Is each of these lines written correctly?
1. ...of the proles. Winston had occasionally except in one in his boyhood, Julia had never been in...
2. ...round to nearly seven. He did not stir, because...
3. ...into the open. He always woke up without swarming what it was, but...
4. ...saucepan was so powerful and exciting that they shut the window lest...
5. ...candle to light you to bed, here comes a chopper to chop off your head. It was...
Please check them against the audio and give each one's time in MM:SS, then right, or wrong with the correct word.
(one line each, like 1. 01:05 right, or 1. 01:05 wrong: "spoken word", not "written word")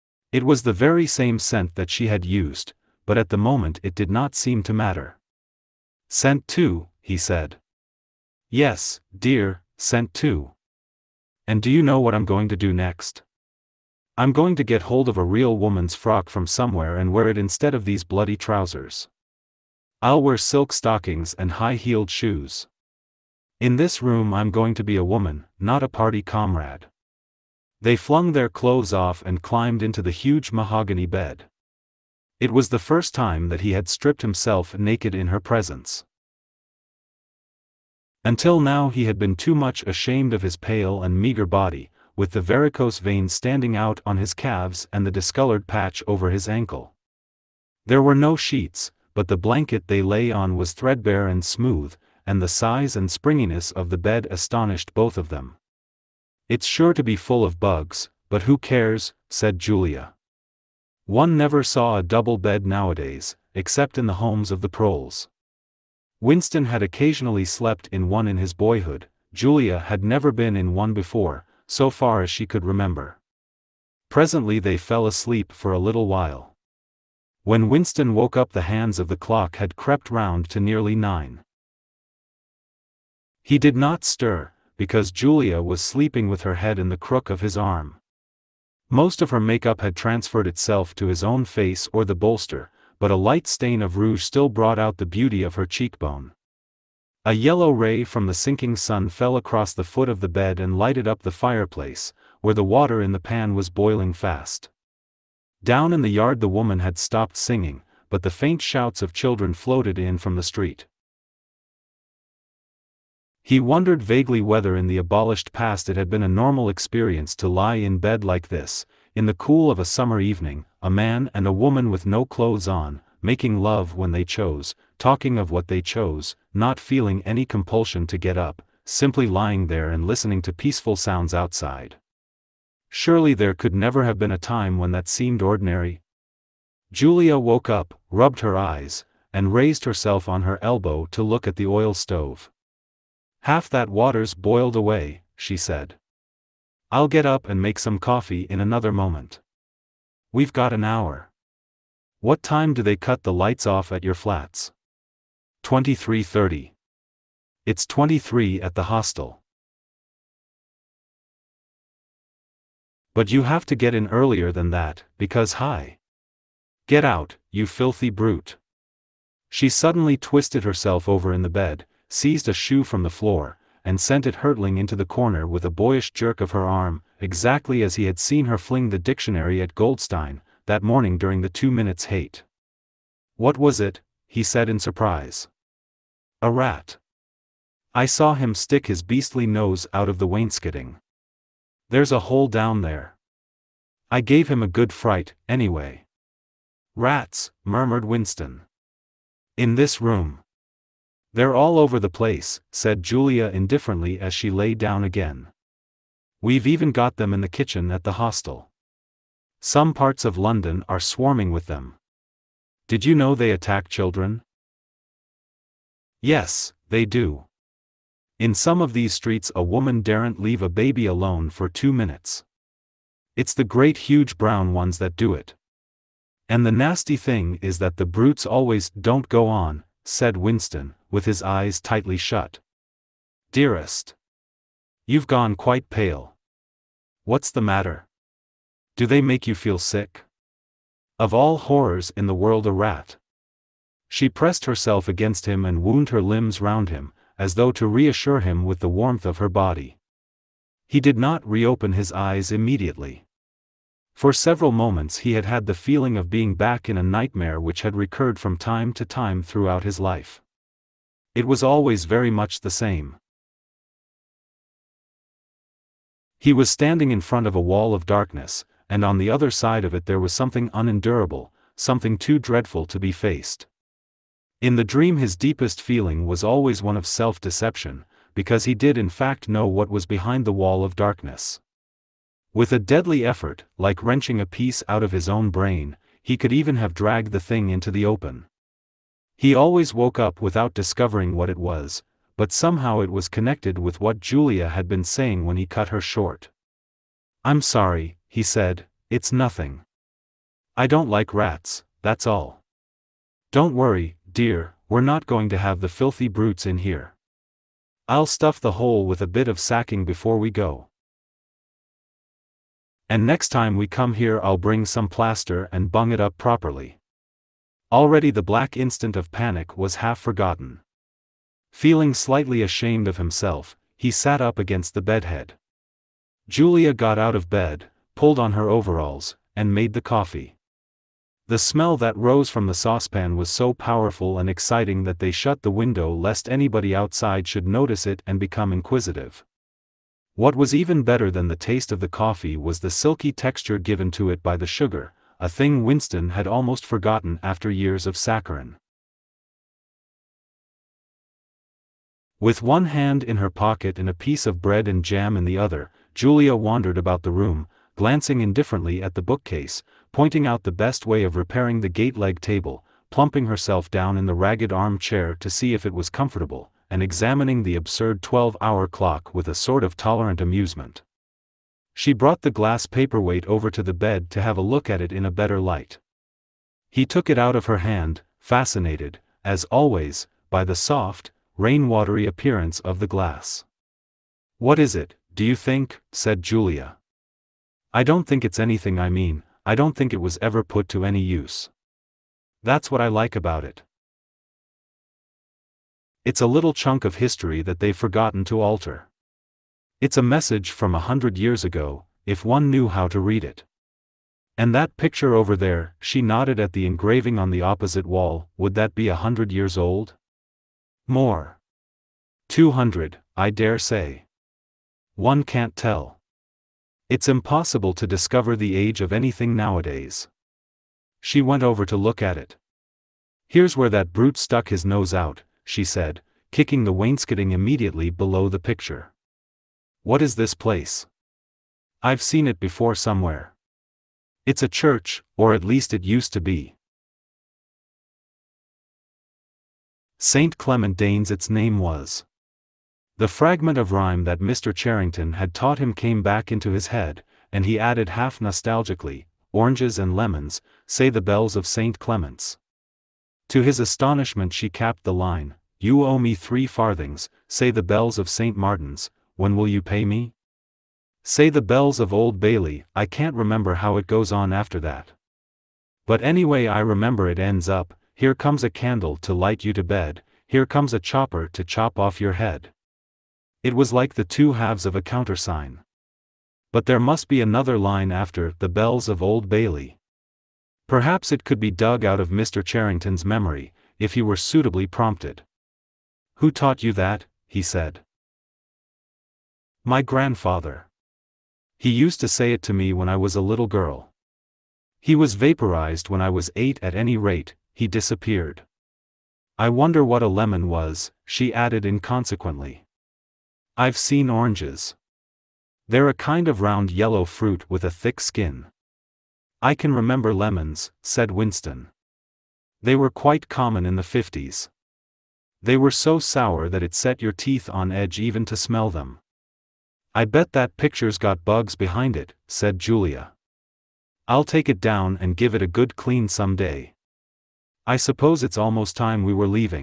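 1. 01:04 wrong: "slept", not "except"
2. 01:20 wrong: "nine", not "seven"
3. 04:47 wrong: "discovering", not "swarming"
4. 05:32 right
5. 07:48 right.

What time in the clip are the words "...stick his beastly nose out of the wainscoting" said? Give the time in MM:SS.
03:08.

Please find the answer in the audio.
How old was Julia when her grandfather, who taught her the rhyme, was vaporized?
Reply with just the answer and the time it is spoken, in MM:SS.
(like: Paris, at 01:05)
8, at 08:16.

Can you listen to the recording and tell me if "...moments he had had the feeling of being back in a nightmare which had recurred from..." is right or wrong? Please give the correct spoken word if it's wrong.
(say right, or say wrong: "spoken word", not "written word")
right.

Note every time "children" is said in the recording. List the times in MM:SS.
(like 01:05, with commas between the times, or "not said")
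01:49, 03:33.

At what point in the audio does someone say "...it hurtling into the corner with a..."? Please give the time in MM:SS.
02:54.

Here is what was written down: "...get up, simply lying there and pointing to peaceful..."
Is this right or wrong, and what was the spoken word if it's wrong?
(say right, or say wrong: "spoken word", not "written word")
wrong: "listening", not "pointing".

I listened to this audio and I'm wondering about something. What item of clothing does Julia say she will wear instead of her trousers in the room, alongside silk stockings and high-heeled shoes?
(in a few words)
a real woman's frock.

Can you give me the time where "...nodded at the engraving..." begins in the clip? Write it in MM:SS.
06:46.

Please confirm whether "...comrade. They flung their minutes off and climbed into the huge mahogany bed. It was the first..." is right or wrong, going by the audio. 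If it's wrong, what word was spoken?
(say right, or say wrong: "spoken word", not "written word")
wrong: "clothes", not "minutes".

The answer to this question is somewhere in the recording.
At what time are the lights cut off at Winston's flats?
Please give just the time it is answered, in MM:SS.
02:35.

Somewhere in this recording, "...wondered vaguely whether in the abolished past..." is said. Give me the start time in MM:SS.
01:53.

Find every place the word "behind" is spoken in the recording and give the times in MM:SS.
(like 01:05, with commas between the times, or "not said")
04:40, 08:41.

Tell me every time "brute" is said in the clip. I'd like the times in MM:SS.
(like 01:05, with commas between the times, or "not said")
02:48, 03:48, 05:06, 07:04.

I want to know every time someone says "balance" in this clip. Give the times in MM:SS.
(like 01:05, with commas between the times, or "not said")
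not said.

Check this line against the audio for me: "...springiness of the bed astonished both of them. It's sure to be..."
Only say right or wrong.
right.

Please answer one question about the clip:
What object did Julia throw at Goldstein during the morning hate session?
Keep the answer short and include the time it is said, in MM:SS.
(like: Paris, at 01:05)
the dictionary, at 02:58.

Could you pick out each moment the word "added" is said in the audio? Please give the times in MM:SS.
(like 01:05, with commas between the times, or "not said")
07:27, 08:21.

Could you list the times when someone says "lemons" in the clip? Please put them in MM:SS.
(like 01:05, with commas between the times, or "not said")
07:30, 08:20, 08:30.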